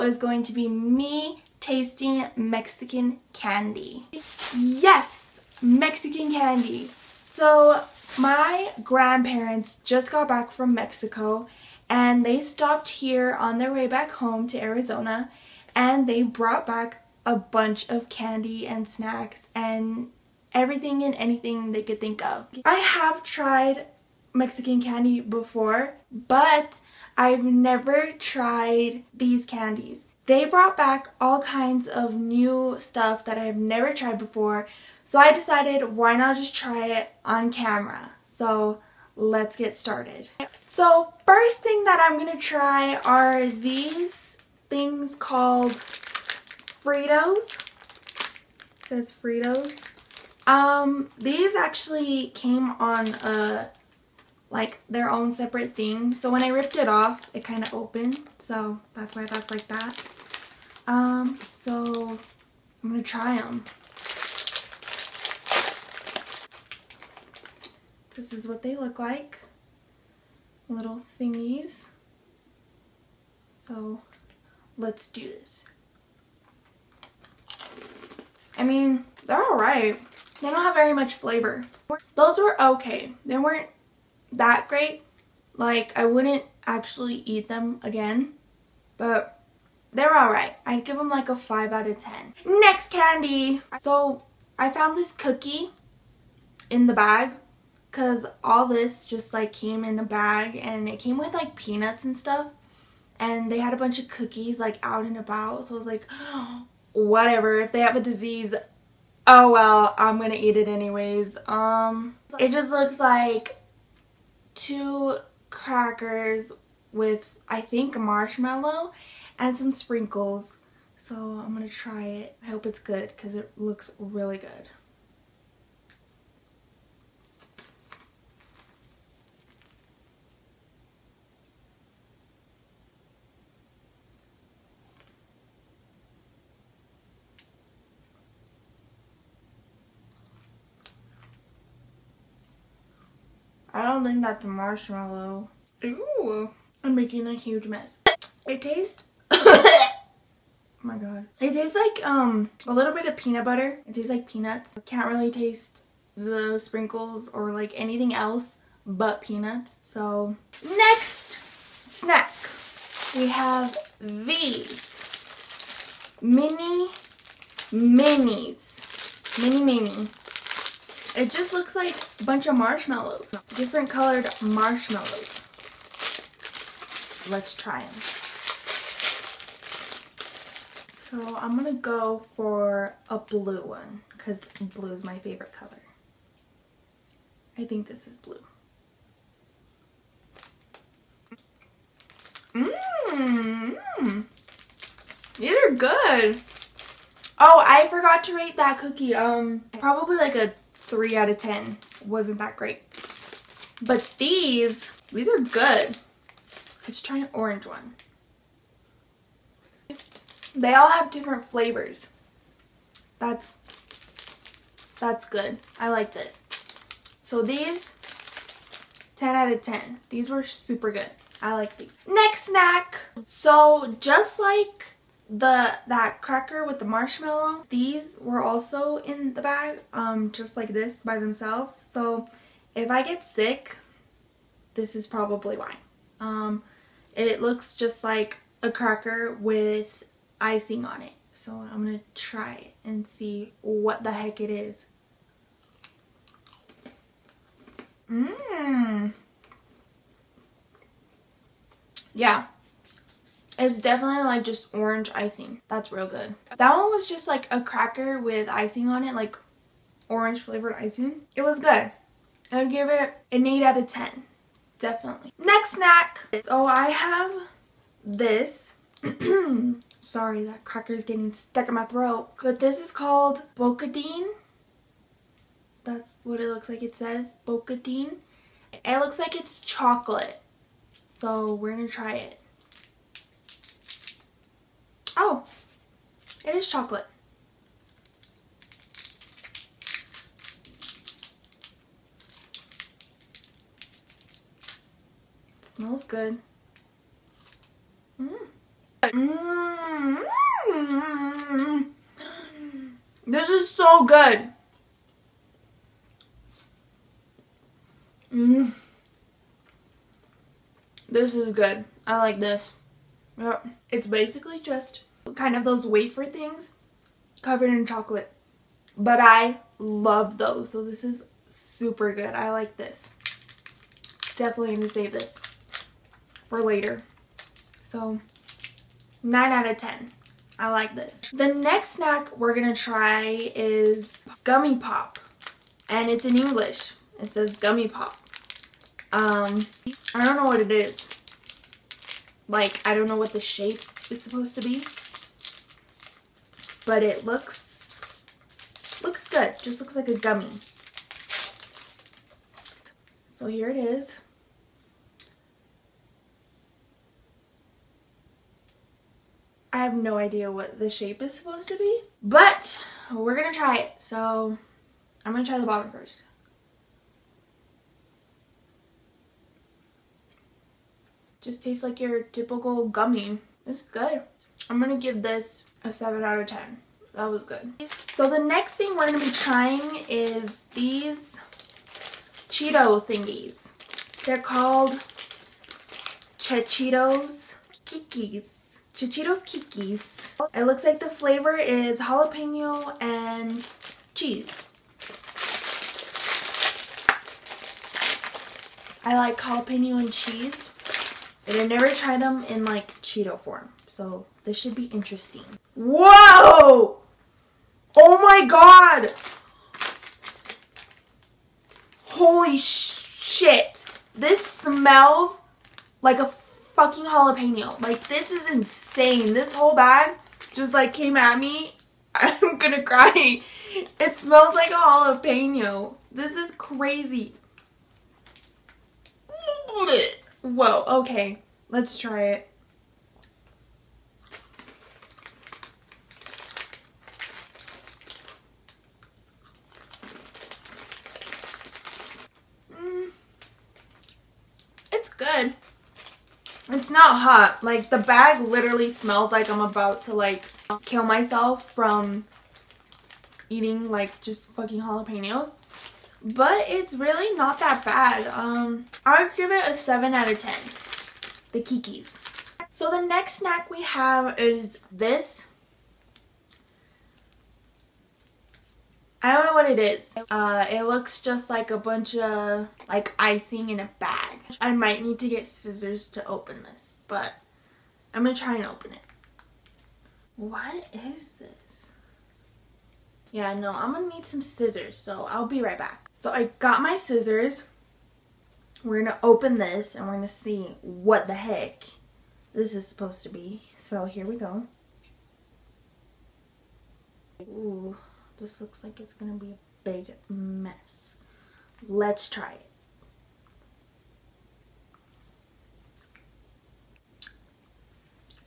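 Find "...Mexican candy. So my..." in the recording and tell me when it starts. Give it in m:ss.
0:05.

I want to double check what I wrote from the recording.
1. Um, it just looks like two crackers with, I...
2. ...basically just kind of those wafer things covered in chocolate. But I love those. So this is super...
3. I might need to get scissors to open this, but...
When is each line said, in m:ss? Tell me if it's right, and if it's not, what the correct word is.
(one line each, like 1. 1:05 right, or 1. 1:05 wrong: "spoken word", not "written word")
1. 1:51 right
2. 5:14 right
3. 7:54 right.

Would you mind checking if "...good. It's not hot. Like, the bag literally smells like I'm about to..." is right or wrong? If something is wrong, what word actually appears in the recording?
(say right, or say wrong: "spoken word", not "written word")
right.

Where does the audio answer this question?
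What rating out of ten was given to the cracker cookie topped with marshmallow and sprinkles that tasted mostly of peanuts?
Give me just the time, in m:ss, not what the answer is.
3:20.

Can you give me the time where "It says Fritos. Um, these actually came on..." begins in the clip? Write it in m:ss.
0:48.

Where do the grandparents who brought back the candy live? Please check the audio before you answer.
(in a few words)
Arizona.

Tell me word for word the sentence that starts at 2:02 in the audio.
I hope it's good because it looks really good.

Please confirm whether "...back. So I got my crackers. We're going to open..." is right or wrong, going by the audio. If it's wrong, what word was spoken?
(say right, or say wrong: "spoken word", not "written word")
wrong: "scissors", not "crackers".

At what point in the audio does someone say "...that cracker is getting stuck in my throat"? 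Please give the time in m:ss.
4:30.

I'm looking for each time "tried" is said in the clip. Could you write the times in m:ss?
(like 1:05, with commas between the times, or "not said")
0:23, 0:28, 0:33, 6:41.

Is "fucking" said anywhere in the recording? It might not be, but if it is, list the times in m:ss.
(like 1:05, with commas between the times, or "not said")
6:56, 7:34.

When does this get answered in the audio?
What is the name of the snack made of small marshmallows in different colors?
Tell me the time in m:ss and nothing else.
2:46.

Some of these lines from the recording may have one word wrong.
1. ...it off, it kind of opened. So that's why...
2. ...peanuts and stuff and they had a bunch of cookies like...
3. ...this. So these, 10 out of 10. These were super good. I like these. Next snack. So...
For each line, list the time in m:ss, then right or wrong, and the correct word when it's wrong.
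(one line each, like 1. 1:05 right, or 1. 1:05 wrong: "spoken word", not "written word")
1. 0:56 right
2. 1:41 right
3. 3:36 right.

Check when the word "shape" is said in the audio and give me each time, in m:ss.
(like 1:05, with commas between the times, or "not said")
5:43, 6:00.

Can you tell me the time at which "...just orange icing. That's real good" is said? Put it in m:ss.
4:14.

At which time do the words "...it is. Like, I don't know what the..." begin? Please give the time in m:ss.
5:40.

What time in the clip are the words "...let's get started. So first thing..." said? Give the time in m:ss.
0:39.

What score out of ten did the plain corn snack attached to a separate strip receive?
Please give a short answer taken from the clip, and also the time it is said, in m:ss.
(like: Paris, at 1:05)
5, at 1:31.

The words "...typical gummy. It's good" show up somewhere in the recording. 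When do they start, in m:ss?
6:12.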